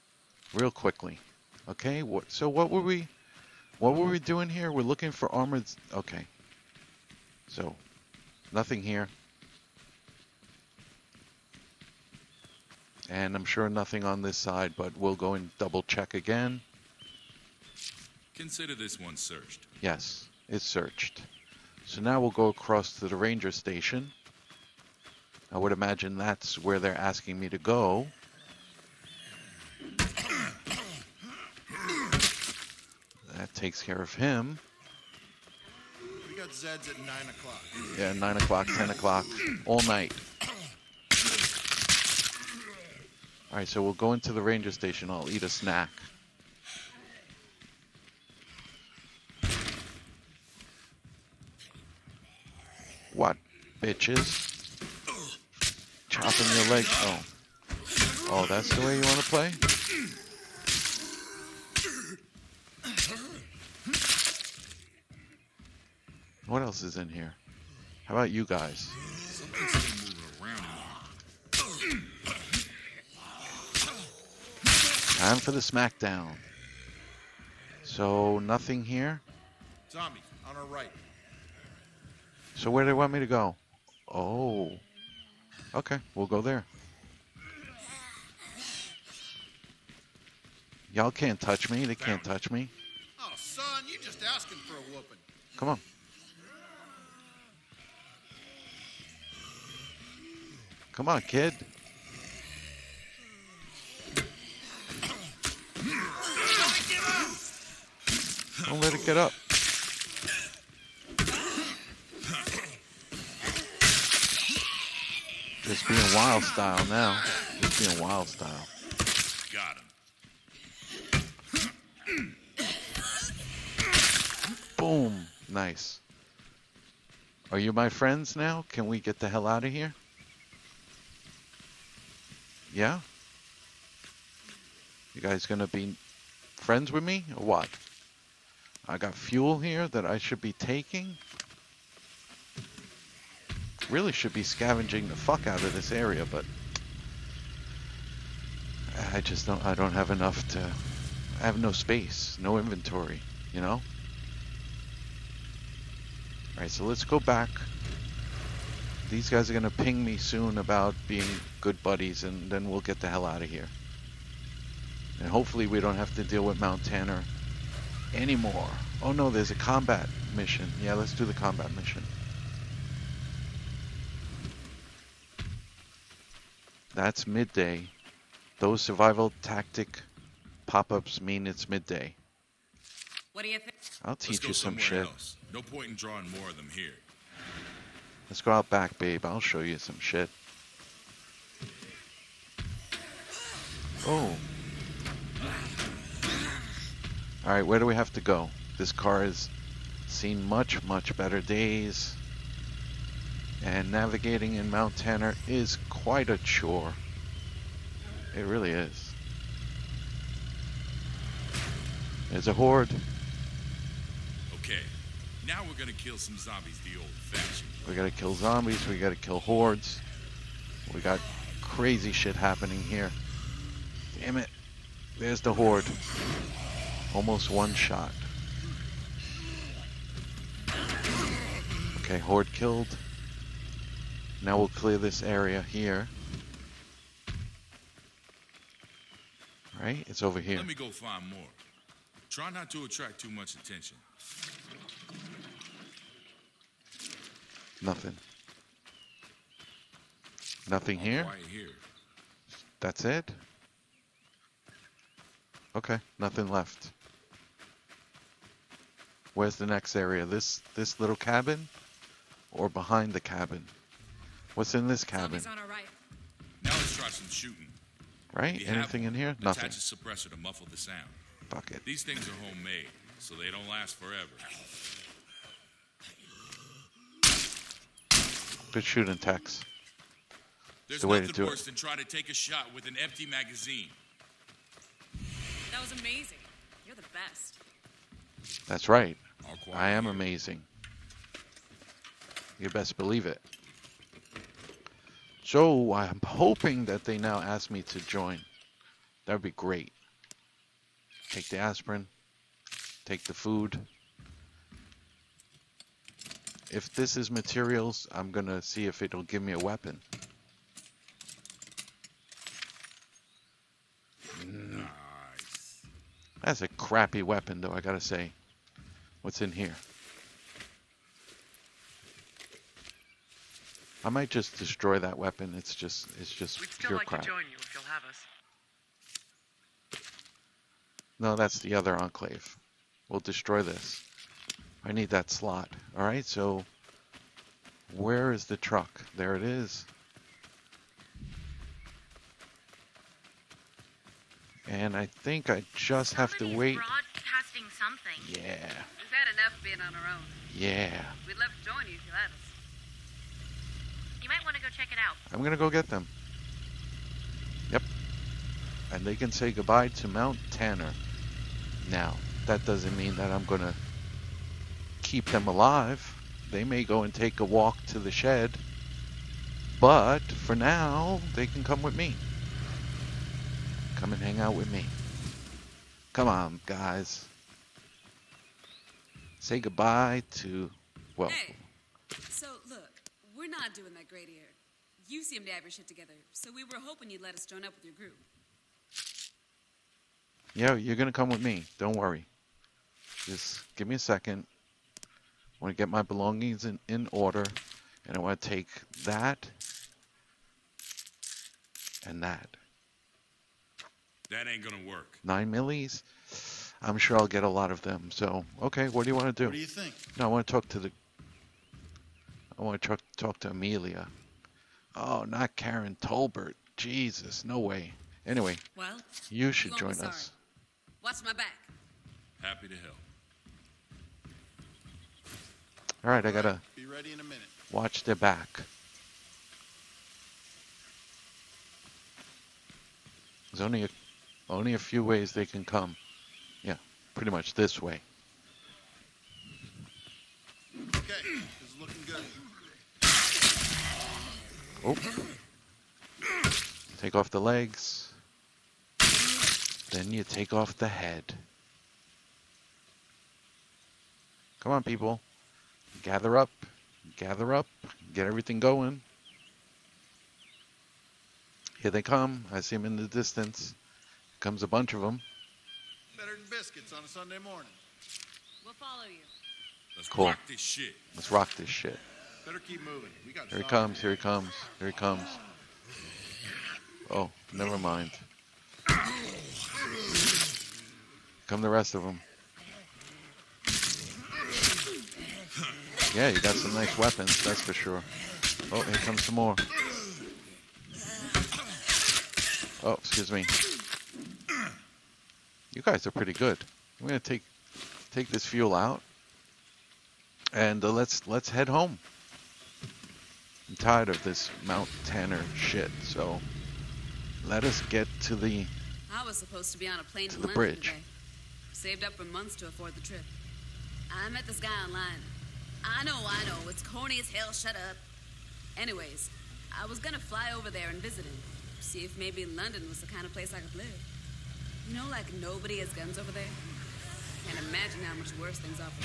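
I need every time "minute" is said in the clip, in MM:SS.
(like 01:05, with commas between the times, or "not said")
07:07.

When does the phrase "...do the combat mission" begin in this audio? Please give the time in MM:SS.
02:51.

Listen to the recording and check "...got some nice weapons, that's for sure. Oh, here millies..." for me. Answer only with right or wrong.
wrong.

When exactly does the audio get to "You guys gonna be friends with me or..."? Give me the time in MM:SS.
02:15.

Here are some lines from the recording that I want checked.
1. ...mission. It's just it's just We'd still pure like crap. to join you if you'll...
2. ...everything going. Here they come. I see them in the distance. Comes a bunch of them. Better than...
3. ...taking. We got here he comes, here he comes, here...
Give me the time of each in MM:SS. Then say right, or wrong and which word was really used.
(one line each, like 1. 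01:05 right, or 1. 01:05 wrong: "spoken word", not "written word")
1. 05:25 wrong: "weapon", not "mission"
2. 07:38 right
3. 07:52 wrong: "moving", not "taking".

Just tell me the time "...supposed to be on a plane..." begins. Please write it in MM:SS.
08:29.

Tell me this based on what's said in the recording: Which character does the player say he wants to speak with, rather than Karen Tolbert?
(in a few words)
Amelia.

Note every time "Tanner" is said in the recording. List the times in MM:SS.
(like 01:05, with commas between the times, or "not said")
02:46, 03:24, 06:00, 08:25.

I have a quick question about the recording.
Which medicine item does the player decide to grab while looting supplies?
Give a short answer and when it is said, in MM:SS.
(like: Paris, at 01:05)
aspirin, at 05:01.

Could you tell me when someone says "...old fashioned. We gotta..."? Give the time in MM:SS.
03:36.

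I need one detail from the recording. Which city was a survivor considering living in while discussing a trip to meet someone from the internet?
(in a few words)
London.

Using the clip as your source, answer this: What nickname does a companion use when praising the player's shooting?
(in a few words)
Tex.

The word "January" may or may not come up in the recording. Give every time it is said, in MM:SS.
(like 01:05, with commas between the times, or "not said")
not said.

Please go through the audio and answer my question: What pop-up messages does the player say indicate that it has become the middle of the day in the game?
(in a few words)
survival tactic pop-ups.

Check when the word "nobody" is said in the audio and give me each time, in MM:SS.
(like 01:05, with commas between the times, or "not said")
08:45.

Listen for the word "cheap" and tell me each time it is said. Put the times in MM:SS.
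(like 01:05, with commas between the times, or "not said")
not said.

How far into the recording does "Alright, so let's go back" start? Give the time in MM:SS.
02:36.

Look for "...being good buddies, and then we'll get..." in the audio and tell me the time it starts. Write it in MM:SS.
02:41.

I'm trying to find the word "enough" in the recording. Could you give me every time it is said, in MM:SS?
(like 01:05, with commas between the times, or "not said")
02:30, 05:49.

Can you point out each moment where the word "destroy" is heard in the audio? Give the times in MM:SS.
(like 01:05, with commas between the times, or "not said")
05:24, 05:33.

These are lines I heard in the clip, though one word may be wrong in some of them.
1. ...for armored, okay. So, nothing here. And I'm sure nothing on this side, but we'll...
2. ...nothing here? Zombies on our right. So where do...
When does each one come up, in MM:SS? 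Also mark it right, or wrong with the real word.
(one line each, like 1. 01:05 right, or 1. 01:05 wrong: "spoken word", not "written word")
1. 00:05 right
2. 01:18 right.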